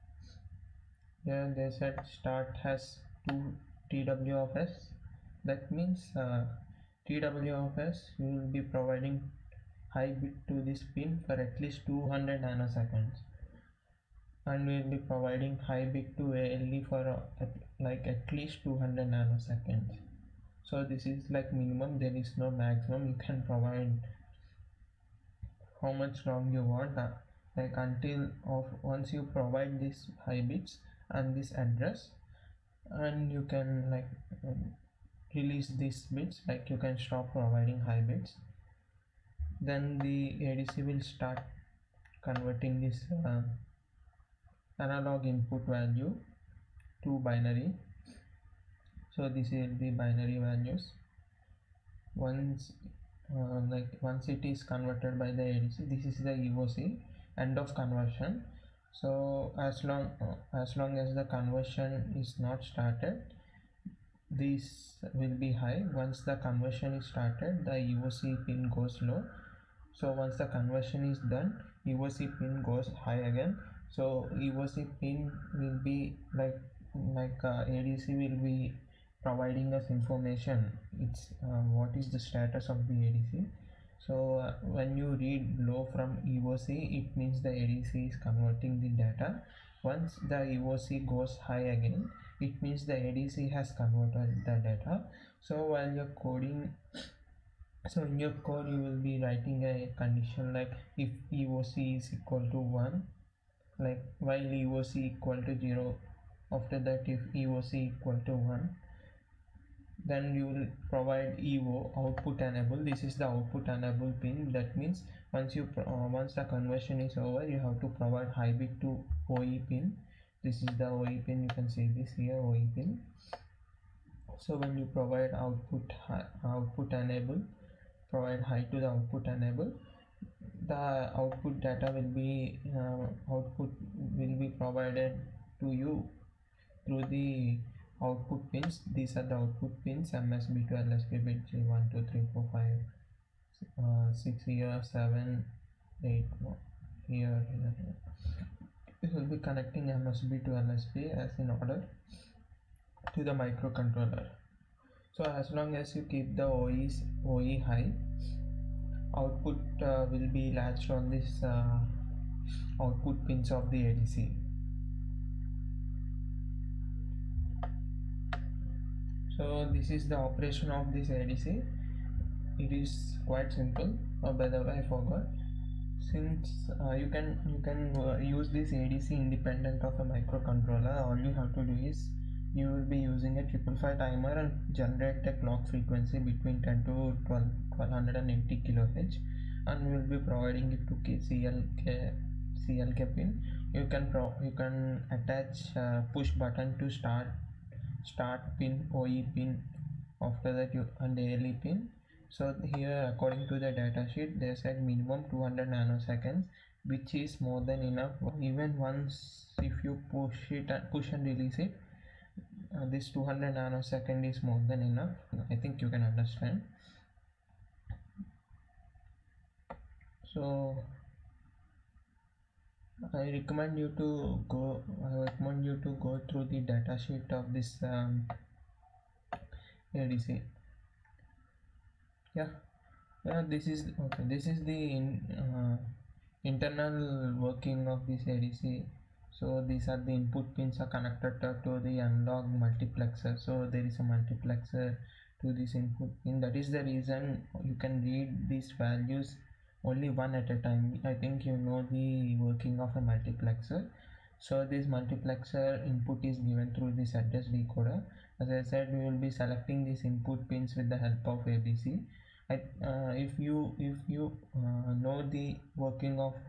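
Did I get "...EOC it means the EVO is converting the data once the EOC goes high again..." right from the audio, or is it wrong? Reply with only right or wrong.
wrong.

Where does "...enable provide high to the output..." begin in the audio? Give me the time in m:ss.
2:06.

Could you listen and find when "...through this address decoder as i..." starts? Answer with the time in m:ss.
4:16.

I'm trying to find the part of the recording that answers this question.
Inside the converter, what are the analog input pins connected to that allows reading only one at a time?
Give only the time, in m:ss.
4:01.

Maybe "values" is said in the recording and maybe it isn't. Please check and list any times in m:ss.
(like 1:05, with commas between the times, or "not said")
0:45, 0:50, 4:08.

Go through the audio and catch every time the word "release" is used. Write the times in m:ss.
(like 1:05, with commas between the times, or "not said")
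0:35, 3:31.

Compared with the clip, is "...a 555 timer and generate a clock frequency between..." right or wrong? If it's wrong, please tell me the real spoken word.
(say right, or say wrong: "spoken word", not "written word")
right.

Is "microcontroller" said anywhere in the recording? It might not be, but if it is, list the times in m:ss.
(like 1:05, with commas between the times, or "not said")
2:33, 3:00.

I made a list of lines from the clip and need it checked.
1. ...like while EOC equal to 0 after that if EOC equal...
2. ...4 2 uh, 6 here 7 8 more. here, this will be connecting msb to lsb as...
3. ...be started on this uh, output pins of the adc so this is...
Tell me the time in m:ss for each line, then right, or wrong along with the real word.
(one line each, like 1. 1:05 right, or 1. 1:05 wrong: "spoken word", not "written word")
1. 1:43 right
2. 2:22 wrong: "5", not "2"
3. 2:40 wrong: "latched", not "started".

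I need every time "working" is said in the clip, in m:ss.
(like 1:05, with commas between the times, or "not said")
3:57, 4:12, 4:25.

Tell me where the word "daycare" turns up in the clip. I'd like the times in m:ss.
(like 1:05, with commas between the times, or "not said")
not said.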